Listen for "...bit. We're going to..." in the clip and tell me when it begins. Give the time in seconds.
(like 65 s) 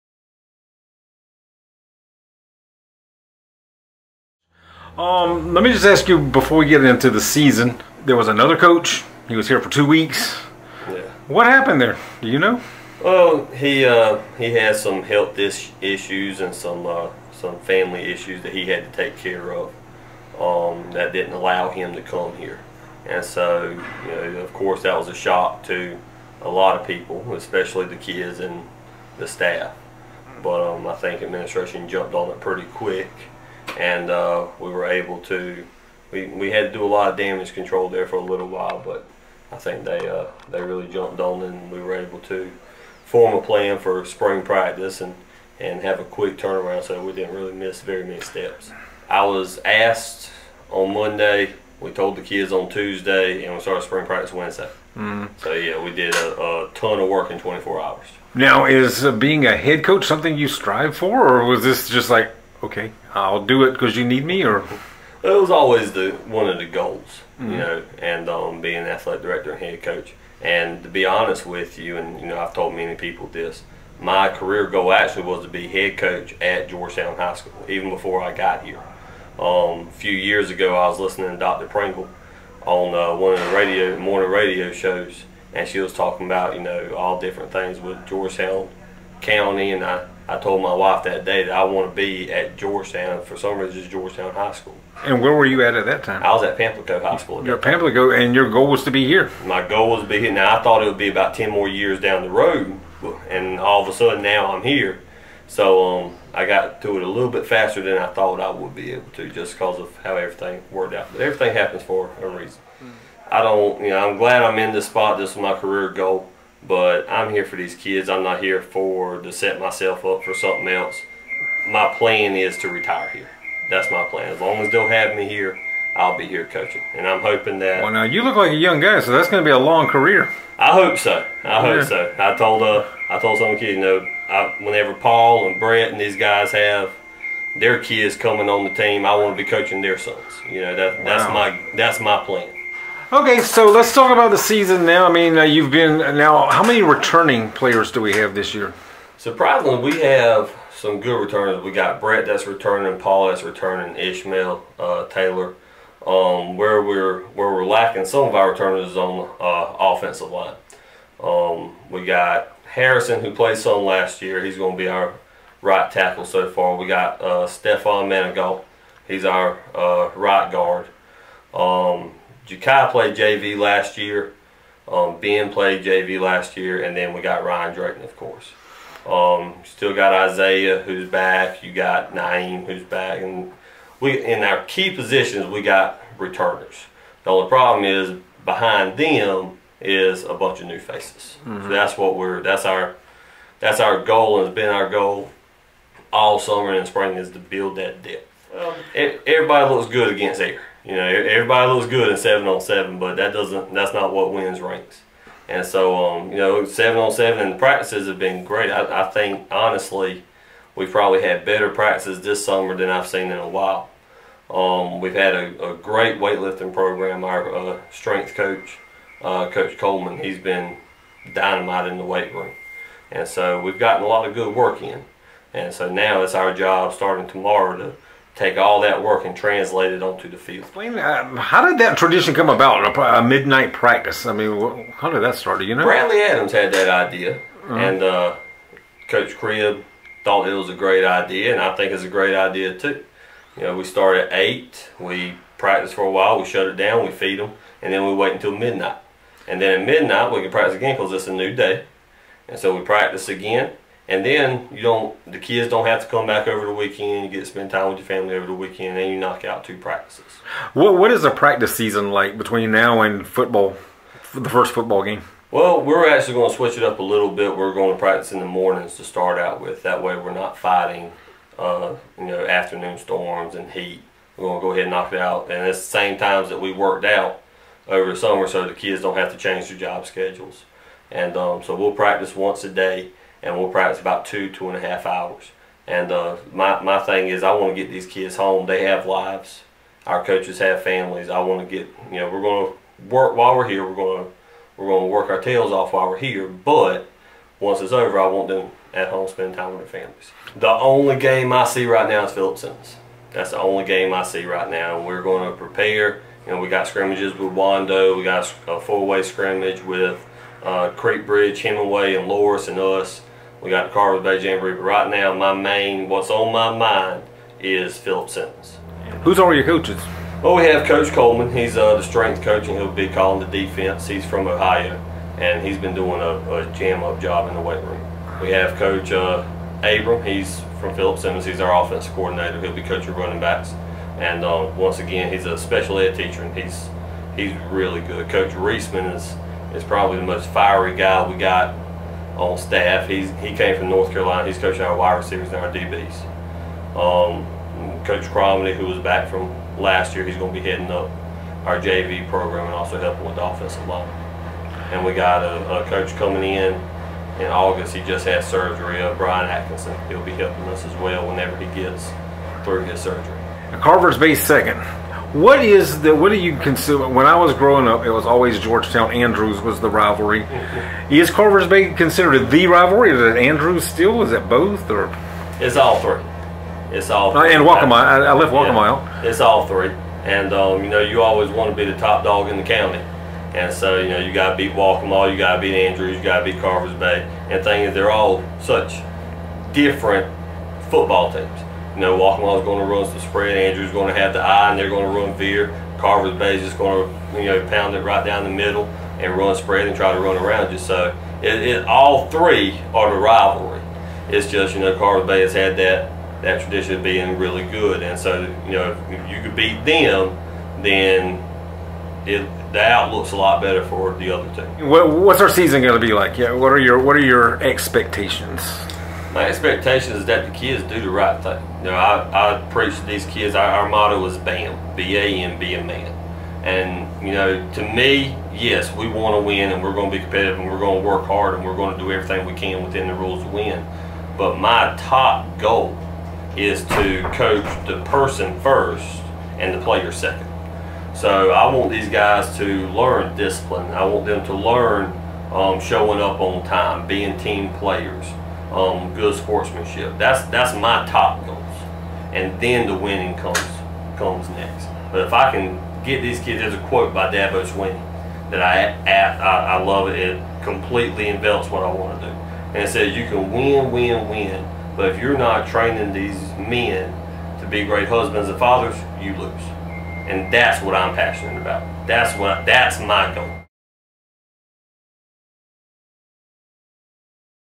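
267 s.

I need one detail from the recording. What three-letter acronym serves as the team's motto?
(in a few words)
BAM.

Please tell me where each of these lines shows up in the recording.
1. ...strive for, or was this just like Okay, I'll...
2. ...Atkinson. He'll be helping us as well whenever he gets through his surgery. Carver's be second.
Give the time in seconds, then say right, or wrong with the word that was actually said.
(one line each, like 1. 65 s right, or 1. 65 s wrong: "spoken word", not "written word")
1. 60 s right
2. 359 s right.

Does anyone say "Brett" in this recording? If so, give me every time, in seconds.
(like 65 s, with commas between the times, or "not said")
135 s, 151 s.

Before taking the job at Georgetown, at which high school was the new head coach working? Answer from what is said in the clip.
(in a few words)
Pamplico High School.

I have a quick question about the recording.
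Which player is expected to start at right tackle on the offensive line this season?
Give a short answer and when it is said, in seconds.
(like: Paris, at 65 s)
Harrison, at 162 s.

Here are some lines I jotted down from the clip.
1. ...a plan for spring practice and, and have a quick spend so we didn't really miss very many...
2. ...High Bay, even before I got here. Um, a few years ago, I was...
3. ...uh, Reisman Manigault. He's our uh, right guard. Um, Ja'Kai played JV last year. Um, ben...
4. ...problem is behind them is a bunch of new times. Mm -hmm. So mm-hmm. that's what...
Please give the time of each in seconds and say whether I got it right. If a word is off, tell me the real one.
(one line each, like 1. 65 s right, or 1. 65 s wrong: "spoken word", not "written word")
1. 43 s wrong: "turnaround", not "spend"
2. 77 s wrong: "School", not "Bay"
3. 167 s wrong: "Stefan", not "Reisman"
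4. 187 s wrong: "faces", not "times".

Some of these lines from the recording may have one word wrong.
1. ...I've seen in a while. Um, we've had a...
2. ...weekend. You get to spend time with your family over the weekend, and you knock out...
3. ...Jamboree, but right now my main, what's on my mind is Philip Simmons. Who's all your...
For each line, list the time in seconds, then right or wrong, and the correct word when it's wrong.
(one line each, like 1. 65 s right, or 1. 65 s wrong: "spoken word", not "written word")
1. 212 s right
2. 256 s right
3. 314 s right.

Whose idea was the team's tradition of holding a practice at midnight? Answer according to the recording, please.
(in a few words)
Bradley Adams.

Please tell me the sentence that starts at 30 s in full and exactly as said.
But um, I think administration jumped on it pretty quick and uh, we were able to.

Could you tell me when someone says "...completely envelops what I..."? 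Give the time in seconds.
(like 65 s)
460 s.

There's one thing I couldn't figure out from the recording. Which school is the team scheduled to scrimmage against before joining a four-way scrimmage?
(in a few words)
Wando.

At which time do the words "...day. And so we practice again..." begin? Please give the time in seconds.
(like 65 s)
251 s.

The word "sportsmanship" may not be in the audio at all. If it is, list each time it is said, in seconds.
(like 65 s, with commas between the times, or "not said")
449 s.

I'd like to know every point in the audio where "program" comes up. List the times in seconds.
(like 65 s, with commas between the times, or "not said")
216 s, 352 s.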